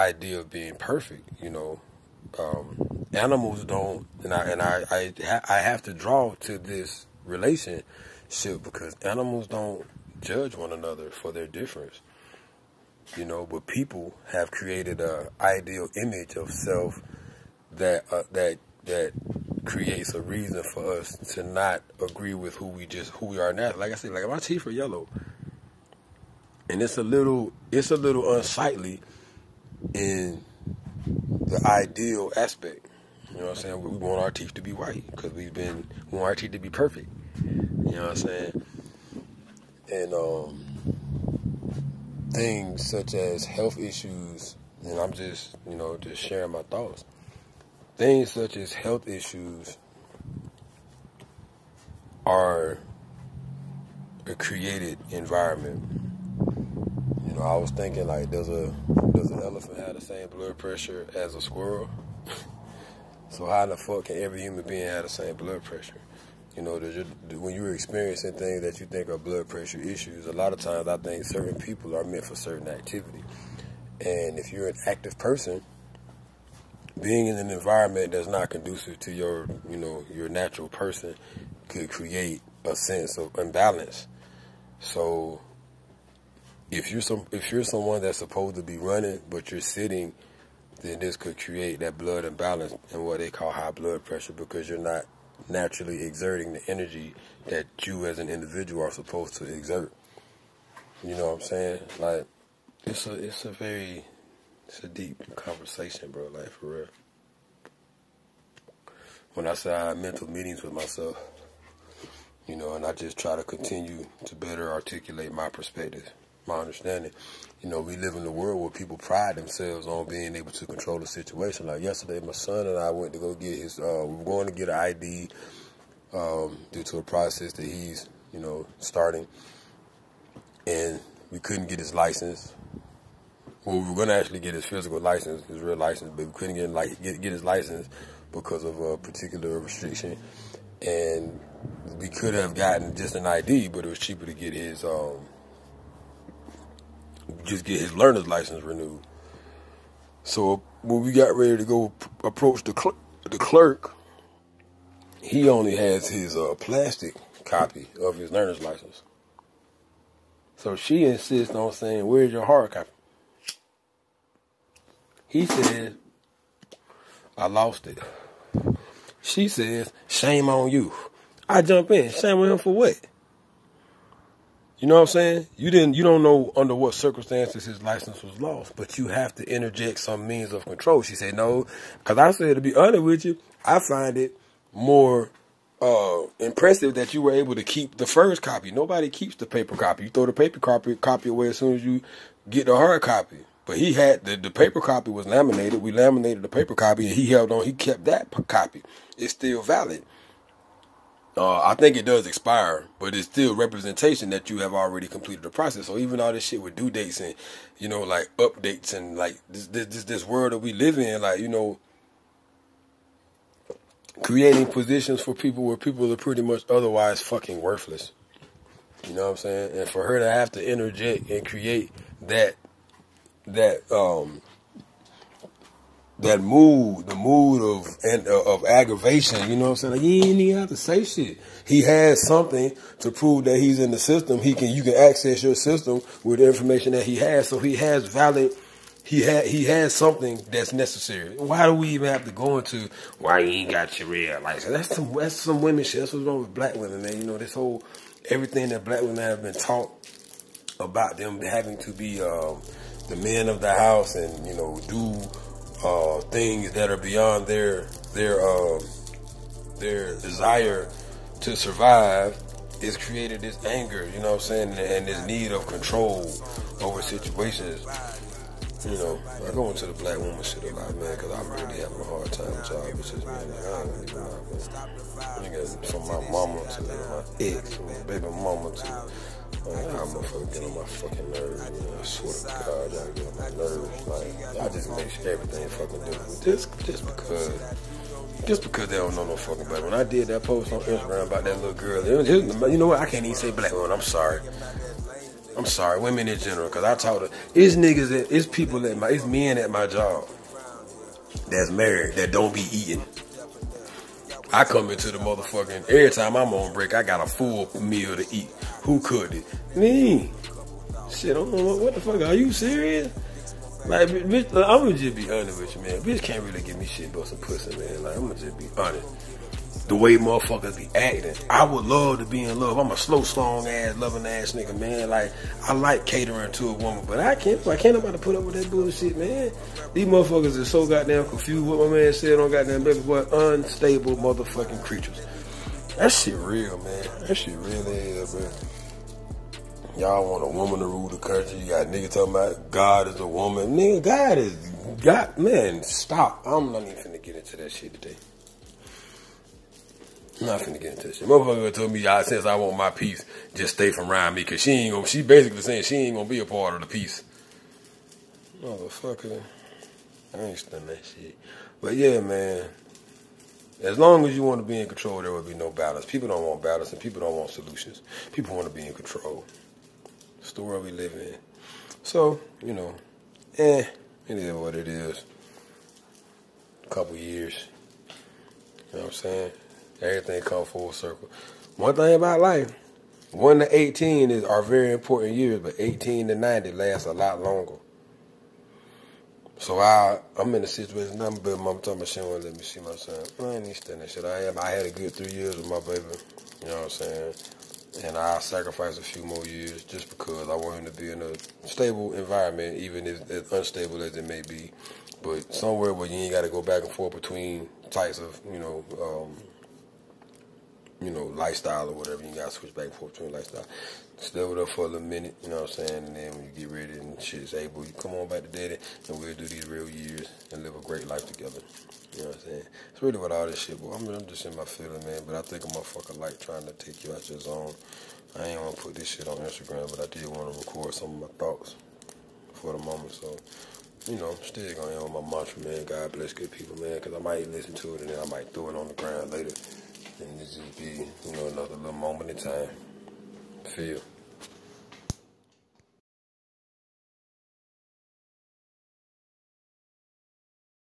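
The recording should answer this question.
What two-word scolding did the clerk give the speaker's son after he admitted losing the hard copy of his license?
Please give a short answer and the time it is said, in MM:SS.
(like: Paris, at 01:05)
Shame on you, at 02:50.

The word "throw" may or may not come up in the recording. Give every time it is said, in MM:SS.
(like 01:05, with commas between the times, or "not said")
03:10, 07:18.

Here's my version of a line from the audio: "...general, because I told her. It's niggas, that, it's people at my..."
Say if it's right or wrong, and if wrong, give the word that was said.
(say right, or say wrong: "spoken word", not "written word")
right.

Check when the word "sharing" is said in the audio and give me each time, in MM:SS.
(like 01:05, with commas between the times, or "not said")
00:46.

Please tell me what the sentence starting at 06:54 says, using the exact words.
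Stay with her for a little minute, you know what I'm saying?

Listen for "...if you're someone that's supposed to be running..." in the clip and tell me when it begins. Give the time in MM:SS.
01:27.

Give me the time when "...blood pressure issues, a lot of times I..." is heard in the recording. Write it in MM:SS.
01:09.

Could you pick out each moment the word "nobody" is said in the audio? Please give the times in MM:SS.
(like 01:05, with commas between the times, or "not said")
03:08, 05:27.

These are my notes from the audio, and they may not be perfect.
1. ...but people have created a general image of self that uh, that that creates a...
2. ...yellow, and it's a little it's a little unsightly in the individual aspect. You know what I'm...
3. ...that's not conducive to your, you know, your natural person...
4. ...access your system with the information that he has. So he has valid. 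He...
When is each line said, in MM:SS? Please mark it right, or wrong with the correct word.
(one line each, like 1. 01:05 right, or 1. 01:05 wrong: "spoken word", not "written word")
1. 00:13 wrong: "ideal", not "general"
2. 00:24 wrong: "ideal", not "individual"
3. 01:18 right
4. 03:54 right.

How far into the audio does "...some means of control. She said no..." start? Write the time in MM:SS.
02:59.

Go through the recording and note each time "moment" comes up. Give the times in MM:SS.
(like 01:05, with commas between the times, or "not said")
07:12, 07:21.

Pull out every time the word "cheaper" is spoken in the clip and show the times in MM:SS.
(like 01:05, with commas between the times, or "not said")
02:23.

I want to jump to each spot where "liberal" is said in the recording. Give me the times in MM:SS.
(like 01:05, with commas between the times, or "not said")
not said.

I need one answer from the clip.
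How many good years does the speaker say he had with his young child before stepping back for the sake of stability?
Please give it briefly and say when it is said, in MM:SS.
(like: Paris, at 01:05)
3, at 06:35.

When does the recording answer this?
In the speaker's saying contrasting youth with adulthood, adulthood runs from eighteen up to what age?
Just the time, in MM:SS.
06:26.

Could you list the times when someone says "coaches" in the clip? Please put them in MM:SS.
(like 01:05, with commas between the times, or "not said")
not said.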